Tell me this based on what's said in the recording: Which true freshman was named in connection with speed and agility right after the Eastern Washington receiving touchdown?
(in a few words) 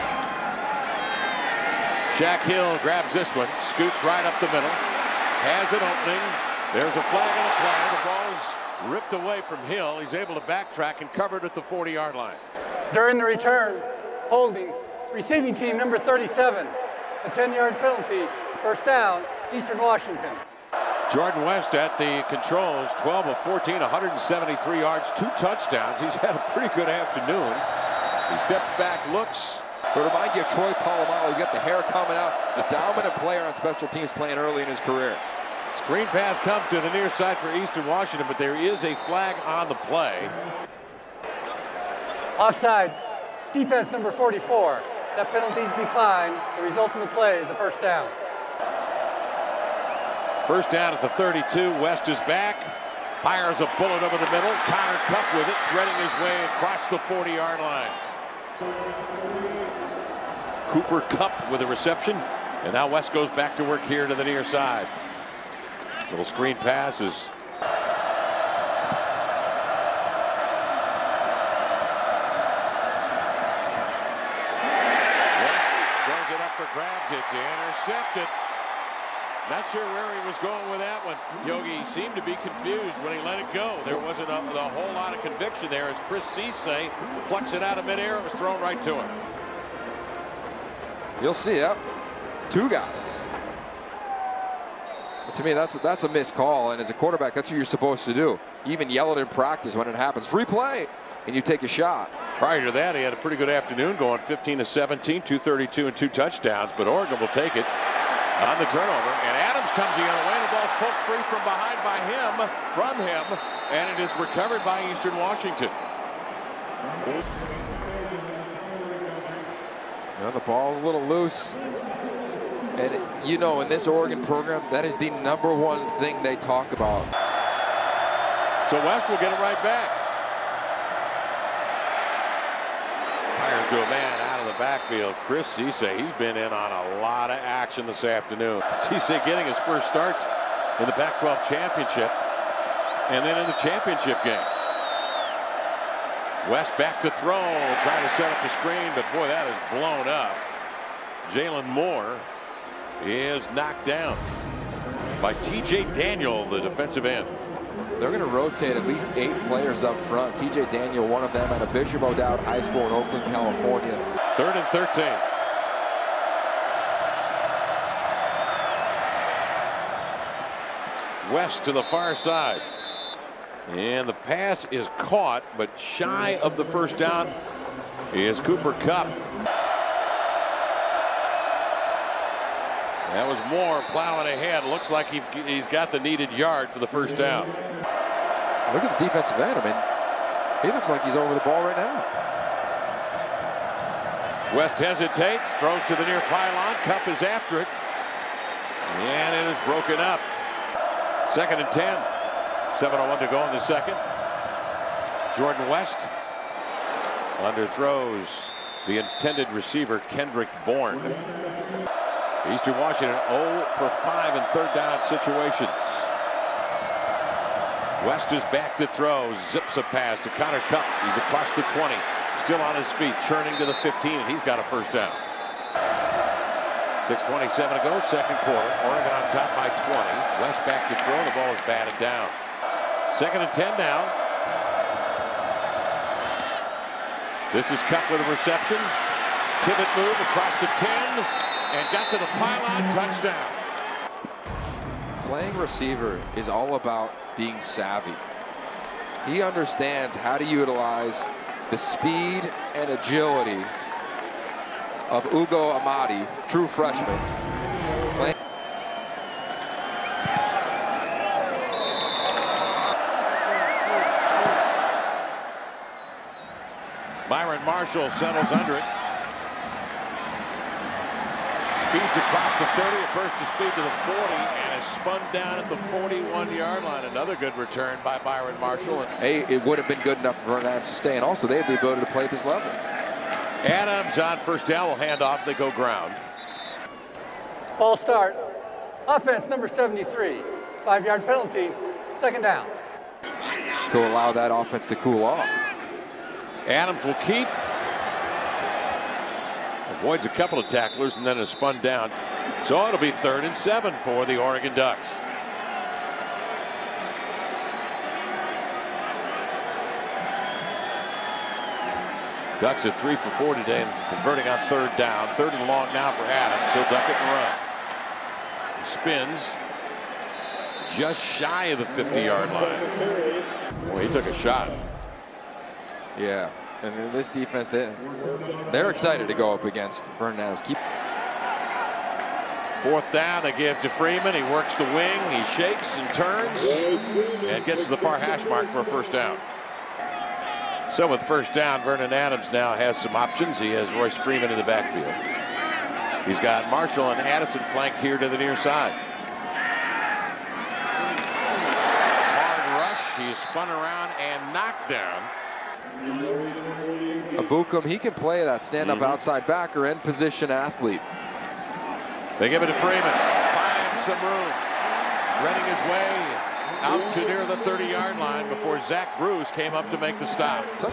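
Ugo Amadi.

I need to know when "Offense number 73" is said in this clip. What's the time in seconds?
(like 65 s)
289 s.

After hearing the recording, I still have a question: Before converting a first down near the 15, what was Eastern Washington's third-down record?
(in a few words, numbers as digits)
0 for 5.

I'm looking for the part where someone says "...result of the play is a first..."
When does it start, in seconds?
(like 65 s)
46 s.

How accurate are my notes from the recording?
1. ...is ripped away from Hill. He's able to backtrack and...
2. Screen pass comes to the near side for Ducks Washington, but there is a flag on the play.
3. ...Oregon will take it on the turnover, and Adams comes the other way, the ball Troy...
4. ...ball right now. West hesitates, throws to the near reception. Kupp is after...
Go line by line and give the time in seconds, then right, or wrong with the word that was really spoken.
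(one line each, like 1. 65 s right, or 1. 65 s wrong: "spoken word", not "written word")
1. 8 s right
2. 35 s wrong: "Eastern", not "Ducks"
3. 106 s wrong: "Poked", not "Troy"
4. 191 s wrong: "pylon", not "reception".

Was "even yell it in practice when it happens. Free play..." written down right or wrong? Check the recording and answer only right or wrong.
right.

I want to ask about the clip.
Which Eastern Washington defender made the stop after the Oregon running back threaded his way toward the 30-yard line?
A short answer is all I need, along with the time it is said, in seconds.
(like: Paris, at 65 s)
Zach Bruce, at 368 s.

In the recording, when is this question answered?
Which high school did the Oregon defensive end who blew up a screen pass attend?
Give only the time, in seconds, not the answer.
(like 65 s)
161 s.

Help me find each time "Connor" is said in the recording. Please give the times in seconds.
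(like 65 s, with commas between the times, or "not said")
54 s, 220 s.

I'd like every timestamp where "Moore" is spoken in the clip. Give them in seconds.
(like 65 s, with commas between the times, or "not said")
151 s, 183 s.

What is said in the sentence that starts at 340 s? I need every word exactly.
So with first down, Vernon Adams now has some options.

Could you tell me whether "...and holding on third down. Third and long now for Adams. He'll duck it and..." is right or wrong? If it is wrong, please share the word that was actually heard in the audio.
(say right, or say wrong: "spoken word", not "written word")
wrong: "converting", not "holding".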